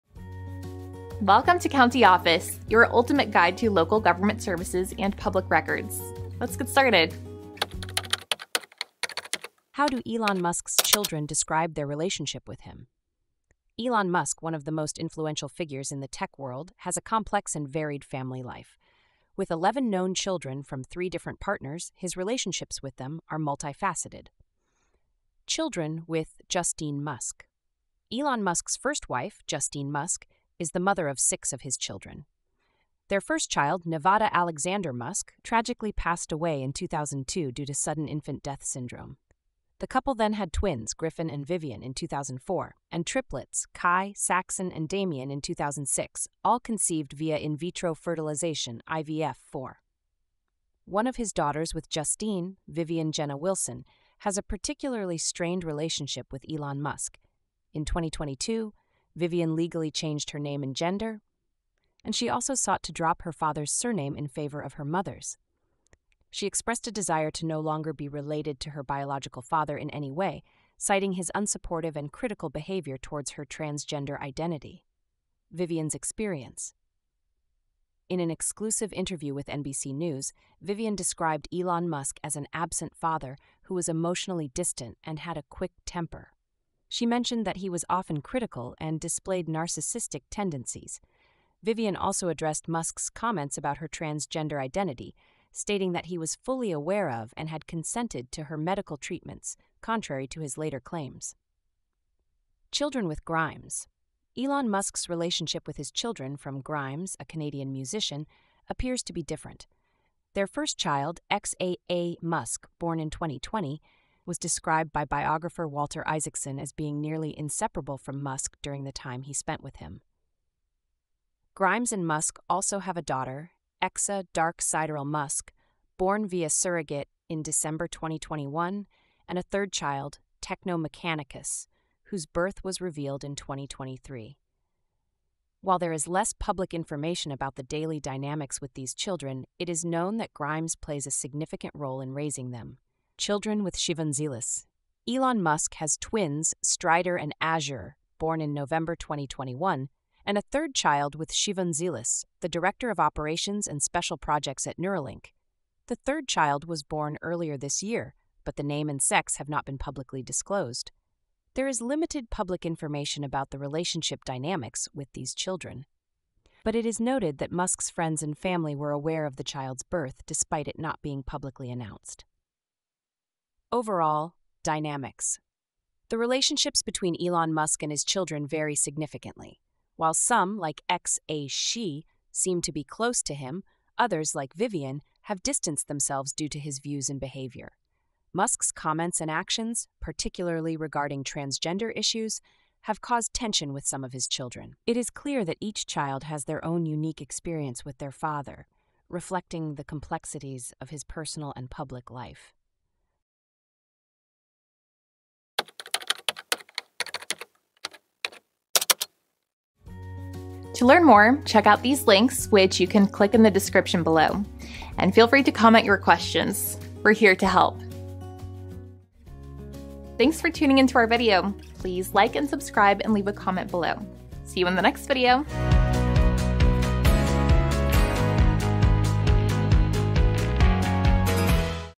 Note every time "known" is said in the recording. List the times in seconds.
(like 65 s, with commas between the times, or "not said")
19 s, 139 s.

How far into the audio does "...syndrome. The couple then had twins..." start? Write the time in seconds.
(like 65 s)
38 s.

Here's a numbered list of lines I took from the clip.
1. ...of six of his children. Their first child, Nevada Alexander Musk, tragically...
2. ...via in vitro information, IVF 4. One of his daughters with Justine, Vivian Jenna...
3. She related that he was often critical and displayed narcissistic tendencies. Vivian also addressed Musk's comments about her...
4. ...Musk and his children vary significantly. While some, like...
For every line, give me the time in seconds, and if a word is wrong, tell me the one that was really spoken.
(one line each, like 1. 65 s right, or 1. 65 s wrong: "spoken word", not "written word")
1. 31 s right
2. 47 s wrong: "fertilization", not "information"
3. 86 s wrong: "mentioned", not "related"
4. 177 s right.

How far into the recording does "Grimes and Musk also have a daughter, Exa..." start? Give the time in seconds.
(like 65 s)
121 s.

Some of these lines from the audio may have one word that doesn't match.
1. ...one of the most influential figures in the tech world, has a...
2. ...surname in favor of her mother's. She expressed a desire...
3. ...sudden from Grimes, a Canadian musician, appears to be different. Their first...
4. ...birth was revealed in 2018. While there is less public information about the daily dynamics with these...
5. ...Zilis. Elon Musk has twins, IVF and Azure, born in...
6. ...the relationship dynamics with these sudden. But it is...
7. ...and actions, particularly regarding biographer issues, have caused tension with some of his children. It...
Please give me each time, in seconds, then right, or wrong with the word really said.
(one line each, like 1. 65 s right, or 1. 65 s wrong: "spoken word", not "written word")
1. 14 s right
2. 63 s right
3. 105 s wrong: "children", not "sudden"
4. 132 s wrong: "2023", not "2018"
5. 144 s wrong: "Strider", not "IVF"
6. 163 s wrong: "children", not "sudden"
7. 189 s wrong: "transgender", not "biographer".